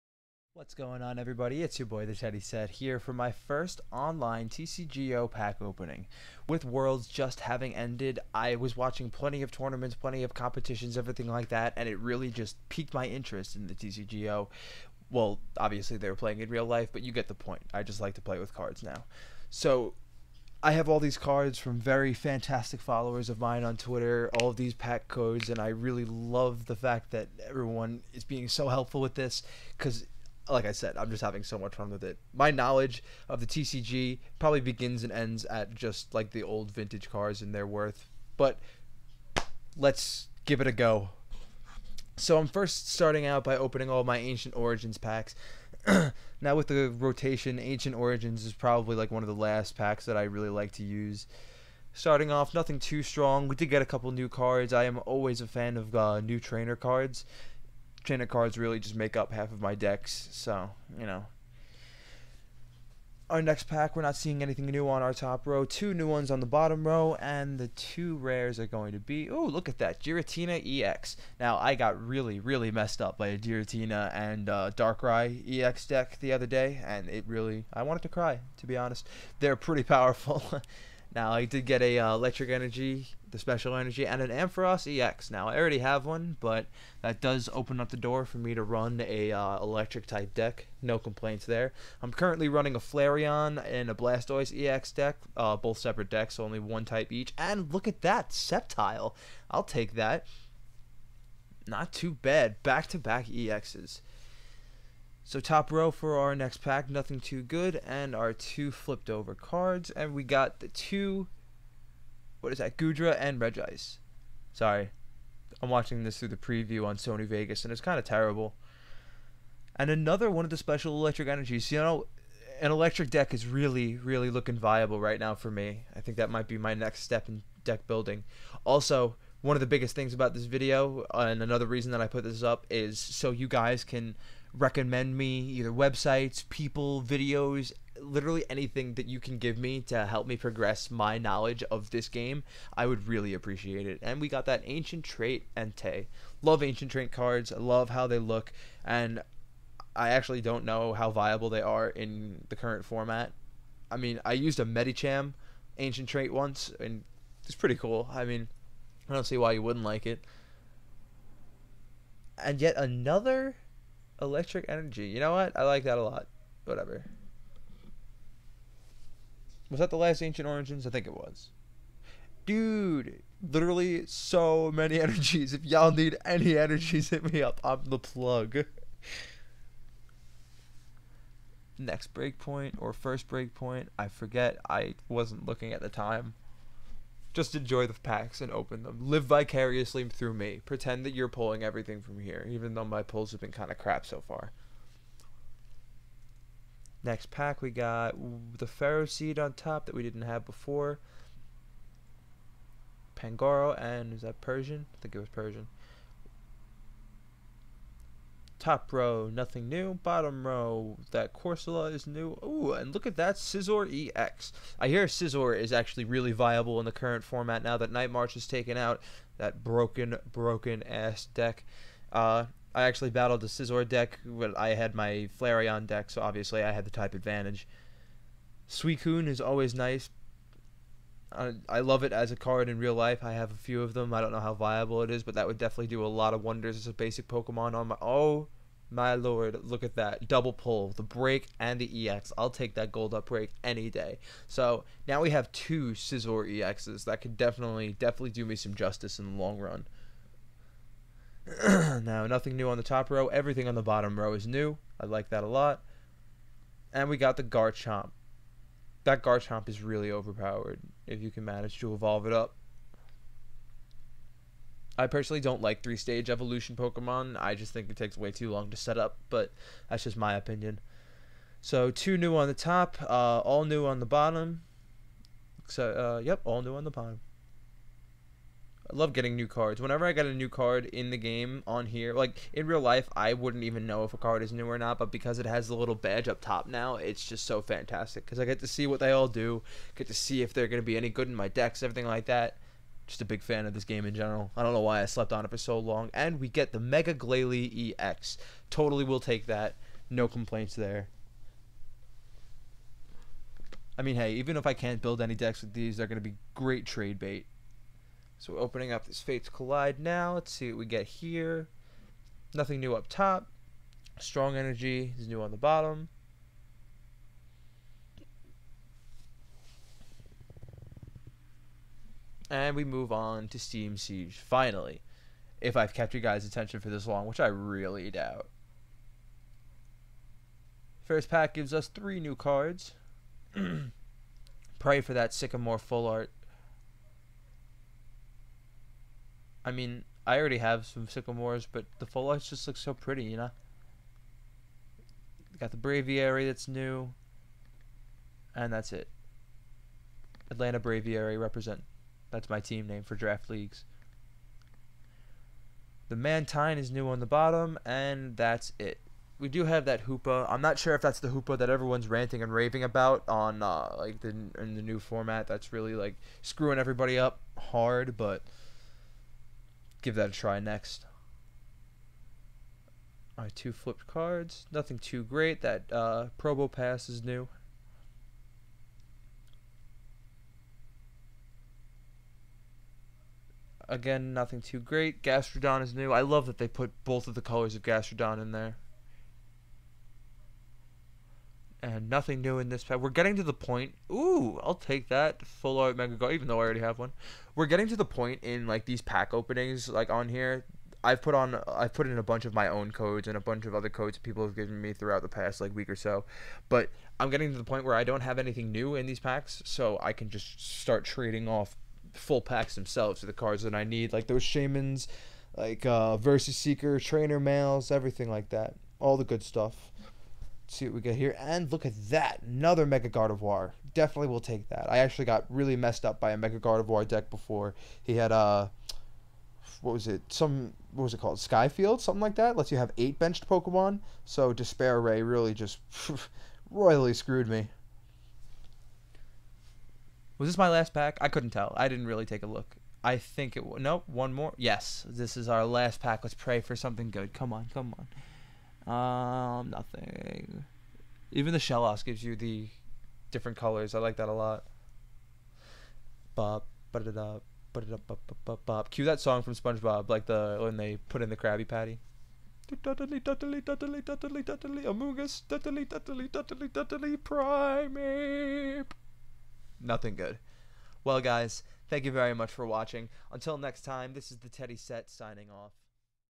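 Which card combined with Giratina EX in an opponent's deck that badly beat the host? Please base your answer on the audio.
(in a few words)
Darkrai EX.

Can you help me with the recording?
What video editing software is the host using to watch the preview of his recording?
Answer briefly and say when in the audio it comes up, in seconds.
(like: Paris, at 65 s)
Sony Vegas, at 116 s.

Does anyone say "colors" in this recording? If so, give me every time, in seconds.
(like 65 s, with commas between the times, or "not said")
387 s, 453 s.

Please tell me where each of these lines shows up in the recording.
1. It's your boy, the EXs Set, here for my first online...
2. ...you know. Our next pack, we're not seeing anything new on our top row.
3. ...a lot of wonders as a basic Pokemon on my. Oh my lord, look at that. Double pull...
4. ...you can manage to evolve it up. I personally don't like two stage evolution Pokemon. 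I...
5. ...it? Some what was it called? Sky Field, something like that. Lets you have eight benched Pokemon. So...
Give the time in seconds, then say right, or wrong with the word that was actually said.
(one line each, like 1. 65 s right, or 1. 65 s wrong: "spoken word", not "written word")
1. 1 s wrong: "Teddy", not "EXs"
2. 60 s right
3. 236 s right
4. 261 s wrong: "three", not "two"
5. 430 s right.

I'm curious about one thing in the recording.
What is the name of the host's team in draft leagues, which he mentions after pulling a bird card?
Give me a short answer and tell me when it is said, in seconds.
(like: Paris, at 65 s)
Atlanta Braviary, at 350 s.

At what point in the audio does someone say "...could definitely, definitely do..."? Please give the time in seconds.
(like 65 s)
247 s.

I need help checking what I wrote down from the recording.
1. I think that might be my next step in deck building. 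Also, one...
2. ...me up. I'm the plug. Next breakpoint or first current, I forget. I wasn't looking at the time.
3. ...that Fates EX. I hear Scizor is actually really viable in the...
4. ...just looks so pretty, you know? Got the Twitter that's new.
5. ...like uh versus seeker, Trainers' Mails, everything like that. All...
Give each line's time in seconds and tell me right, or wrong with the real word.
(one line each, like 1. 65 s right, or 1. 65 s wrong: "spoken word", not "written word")
1. 125 s right
2. 177 s wrong: "breakpoint", not "current"
3. 213 s wrong: "Scizor", not "Fates"
4. 342 s wrong: "Braviary", not "Twitter"
5. 415 s right.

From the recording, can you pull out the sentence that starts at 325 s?
If I've kept you guys' attention for this long, which I really doubt.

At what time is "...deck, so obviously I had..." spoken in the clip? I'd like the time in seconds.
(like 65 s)
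225 s.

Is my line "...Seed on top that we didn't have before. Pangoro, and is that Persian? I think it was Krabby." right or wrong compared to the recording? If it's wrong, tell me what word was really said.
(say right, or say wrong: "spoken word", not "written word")
wrong: "Persian", not "Krabby".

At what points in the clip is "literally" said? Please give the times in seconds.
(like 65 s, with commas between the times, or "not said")
137 s, 173 s.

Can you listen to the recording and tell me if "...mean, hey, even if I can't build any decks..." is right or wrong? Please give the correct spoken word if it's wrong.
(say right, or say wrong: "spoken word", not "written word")
right.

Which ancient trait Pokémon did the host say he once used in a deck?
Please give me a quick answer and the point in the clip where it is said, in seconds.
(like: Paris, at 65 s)
Medicham, at 154 s.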